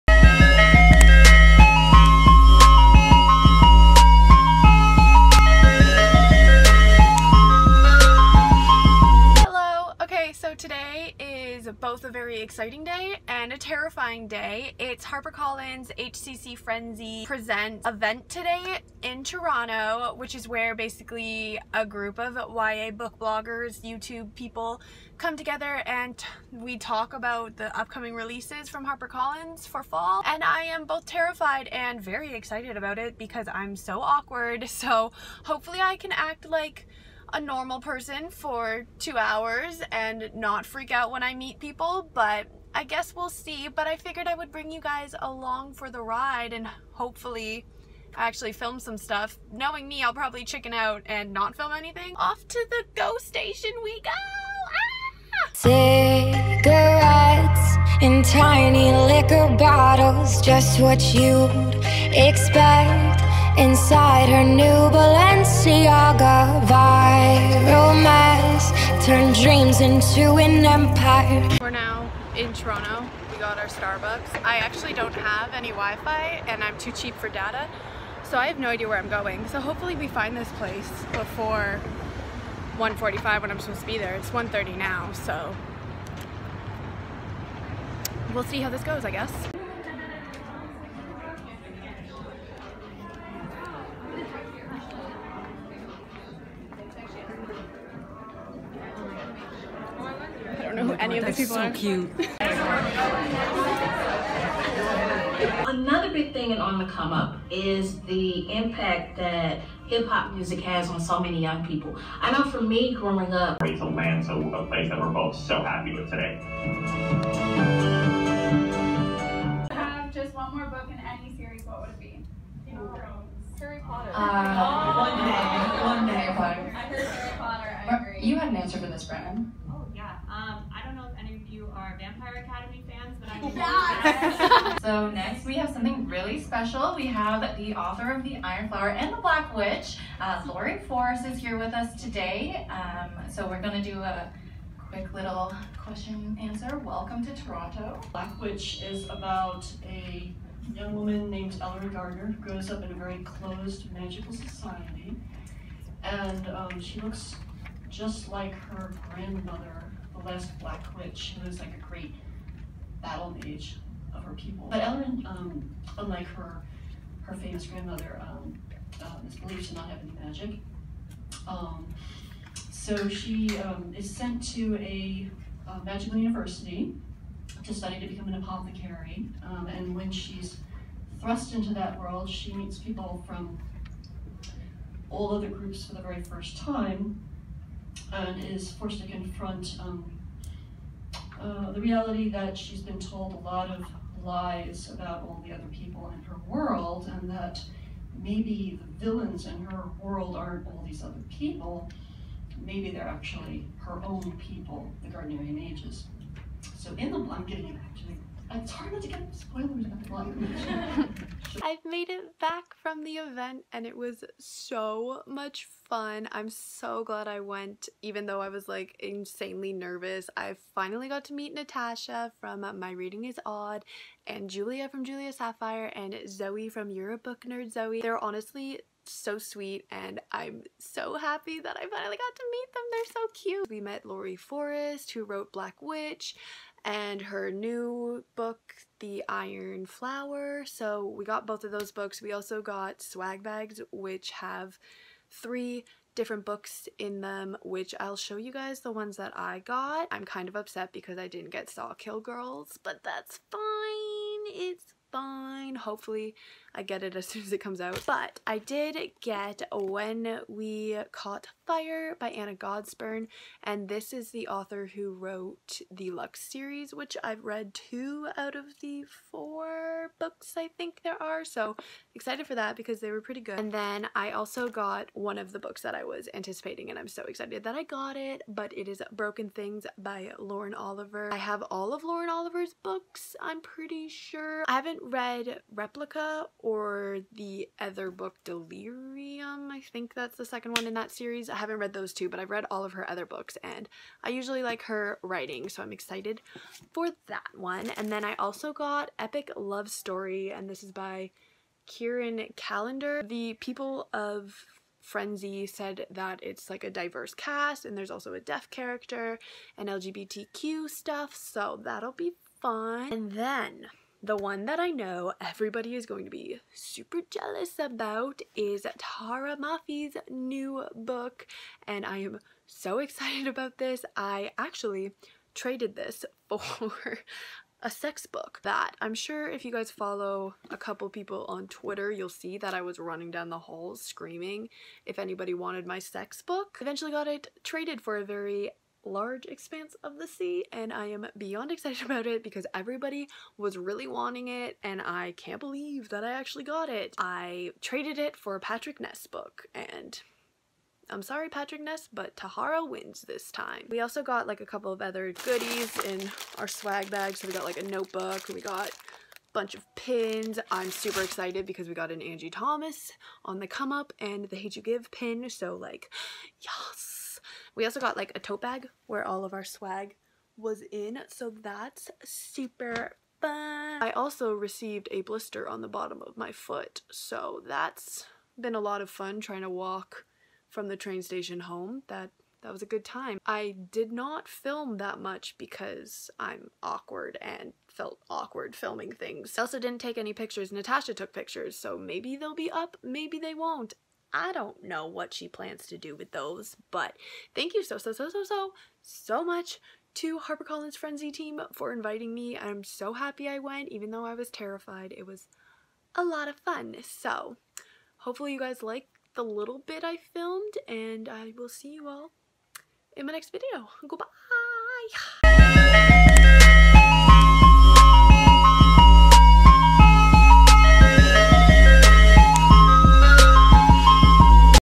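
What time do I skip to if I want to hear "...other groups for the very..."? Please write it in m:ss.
3:05.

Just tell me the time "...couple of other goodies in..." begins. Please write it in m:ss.
5:54.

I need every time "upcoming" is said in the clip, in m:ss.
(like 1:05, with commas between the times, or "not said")
0:27.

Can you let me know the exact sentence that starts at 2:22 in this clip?
Um, so we're gonna do a quick little question answer.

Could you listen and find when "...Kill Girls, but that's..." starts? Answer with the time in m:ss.
4:11.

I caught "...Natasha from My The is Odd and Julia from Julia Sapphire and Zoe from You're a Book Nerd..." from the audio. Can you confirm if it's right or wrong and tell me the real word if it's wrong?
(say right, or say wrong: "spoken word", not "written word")
wrong: "Reading", not "The".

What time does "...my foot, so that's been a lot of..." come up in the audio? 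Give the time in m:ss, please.
6:16.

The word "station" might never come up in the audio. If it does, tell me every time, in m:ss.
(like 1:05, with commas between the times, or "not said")
0:53, 6:21.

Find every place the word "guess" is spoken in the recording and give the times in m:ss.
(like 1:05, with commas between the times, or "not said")
0:42, 1:29.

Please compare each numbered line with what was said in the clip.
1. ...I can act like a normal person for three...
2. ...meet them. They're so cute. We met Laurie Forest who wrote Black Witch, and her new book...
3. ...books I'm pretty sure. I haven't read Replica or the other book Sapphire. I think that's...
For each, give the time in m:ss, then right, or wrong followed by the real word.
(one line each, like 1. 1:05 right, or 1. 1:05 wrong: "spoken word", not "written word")
1. 0:35 wrong: "two", not "three"
2. 3:52 right
3. 4:42 wrong: "Delirium", not "Sapphire".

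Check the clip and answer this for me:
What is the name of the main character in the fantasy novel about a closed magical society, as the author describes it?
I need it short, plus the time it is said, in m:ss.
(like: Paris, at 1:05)
Elloren Gardner, at 2:31.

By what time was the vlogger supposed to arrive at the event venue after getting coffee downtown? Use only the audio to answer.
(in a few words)
1:45.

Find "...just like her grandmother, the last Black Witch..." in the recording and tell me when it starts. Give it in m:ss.
2:37.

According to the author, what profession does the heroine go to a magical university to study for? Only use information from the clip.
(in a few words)
apothecary.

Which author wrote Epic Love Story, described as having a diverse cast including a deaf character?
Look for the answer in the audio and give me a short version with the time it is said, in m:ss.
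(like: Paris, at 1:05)
Kacen Callender, at 5:01.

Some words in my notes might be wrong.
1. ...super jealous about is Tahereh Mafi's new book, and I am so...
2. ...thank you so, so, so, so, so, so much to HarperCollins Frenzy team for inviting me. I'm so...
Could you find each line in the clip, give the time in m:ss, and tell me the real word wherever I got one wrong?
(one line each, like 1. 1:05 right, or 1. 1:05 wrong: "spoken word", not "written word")
1. 5:16 right
2. 6:37 right.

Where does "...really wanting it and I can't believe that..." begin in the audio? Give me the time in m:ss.
5:43.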